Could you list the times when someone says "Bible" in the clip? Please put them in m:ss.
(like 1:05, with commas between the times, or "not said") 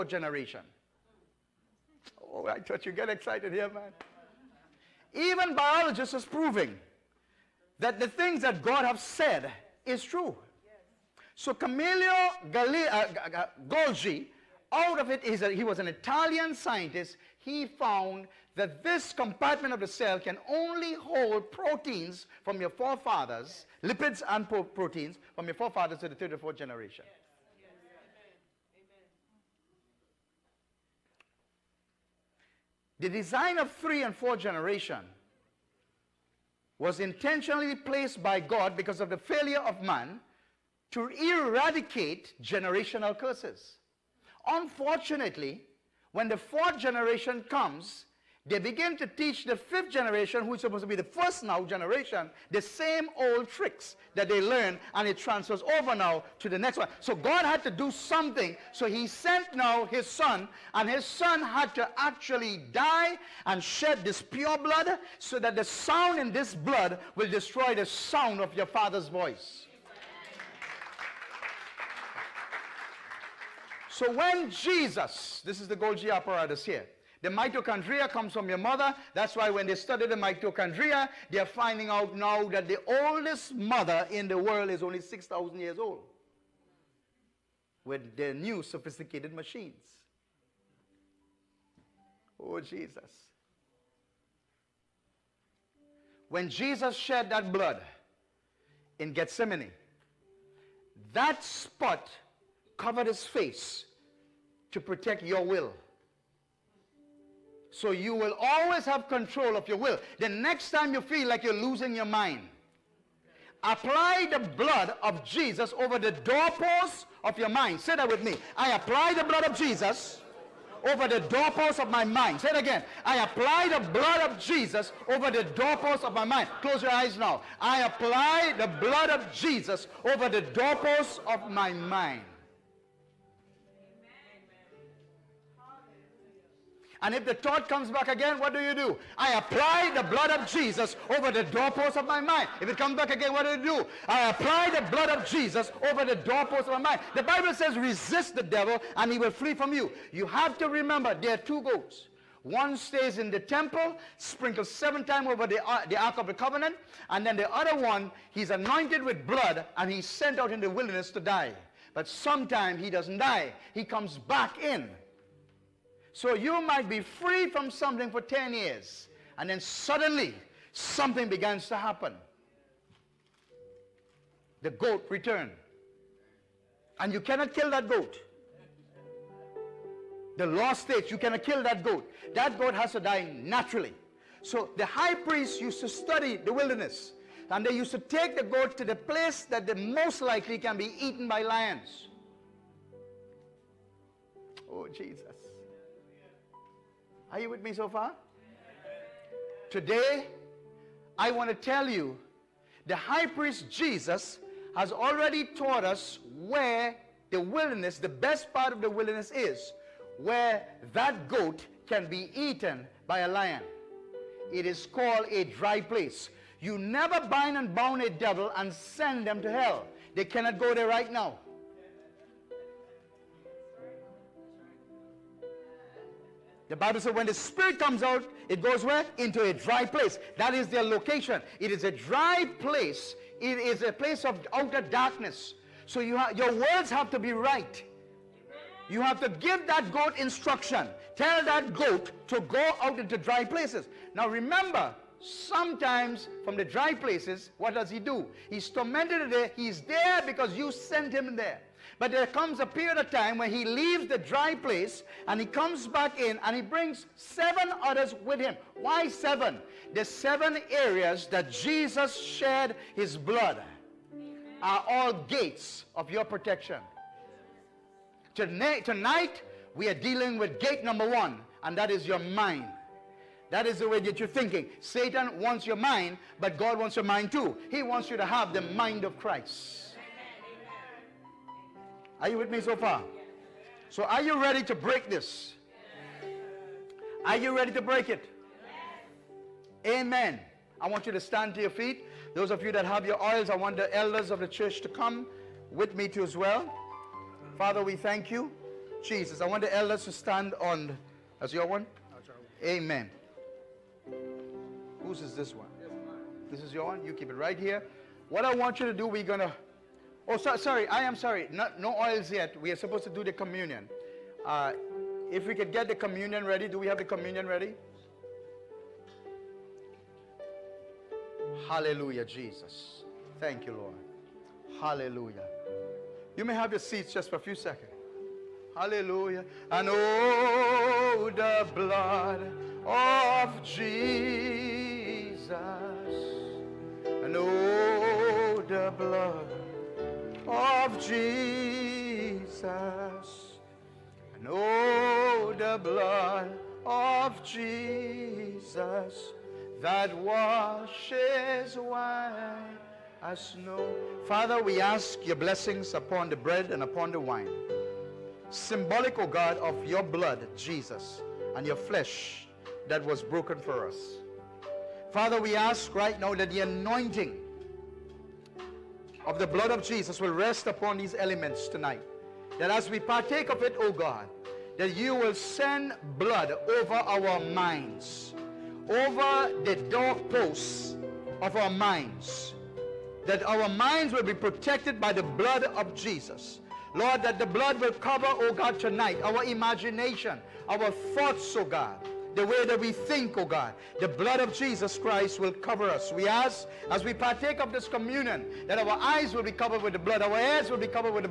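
2:27, 3:46.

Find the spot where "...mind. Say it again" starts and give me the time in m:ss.
2:02.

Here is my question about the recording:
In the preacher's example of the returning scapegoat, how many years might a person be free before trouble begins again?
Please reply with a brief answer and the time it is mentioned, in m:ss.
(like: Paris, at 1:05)
10 years, at 2:48.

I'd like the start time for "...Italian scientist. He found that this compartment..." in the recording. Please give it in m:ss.
0:15.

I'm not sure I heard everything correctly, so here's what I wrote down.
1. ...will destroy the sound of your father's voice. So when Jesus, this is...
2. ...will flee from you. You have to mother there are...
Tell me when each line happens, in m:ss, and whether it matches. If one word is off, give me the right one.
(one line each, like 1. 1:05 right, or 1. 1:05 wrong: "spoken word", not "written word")
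1. 1:07 right
2. 2:29 wrong: "remember", not "mother".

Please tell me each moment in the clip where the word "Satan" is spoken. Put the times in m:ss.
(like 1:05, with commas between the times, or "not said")
4:34.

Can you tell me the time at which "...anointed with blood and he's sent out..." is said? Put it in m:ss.
2:38.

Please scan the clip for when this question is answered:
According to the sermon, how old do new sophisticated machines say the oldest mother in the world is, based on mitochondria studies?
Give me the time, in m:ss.
1:25.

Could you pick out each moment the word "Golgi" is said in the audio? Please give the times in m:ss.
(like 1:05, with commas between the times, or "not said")
0:13, 1:15.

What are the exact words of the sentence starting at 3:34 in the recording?
It is called a dry place.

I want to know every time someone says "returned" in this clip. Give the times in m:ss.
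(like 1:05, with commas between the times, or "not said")
2:55.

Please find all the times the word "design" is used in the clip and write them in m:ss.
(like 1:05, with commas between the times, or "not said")
0:33.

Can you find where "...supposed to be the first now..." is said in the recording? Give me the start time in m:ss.
0:50.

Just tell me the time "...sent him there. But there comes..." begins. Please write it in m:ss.
4:10.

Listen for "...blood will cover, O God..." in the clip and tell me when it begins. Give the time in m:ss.
6:27.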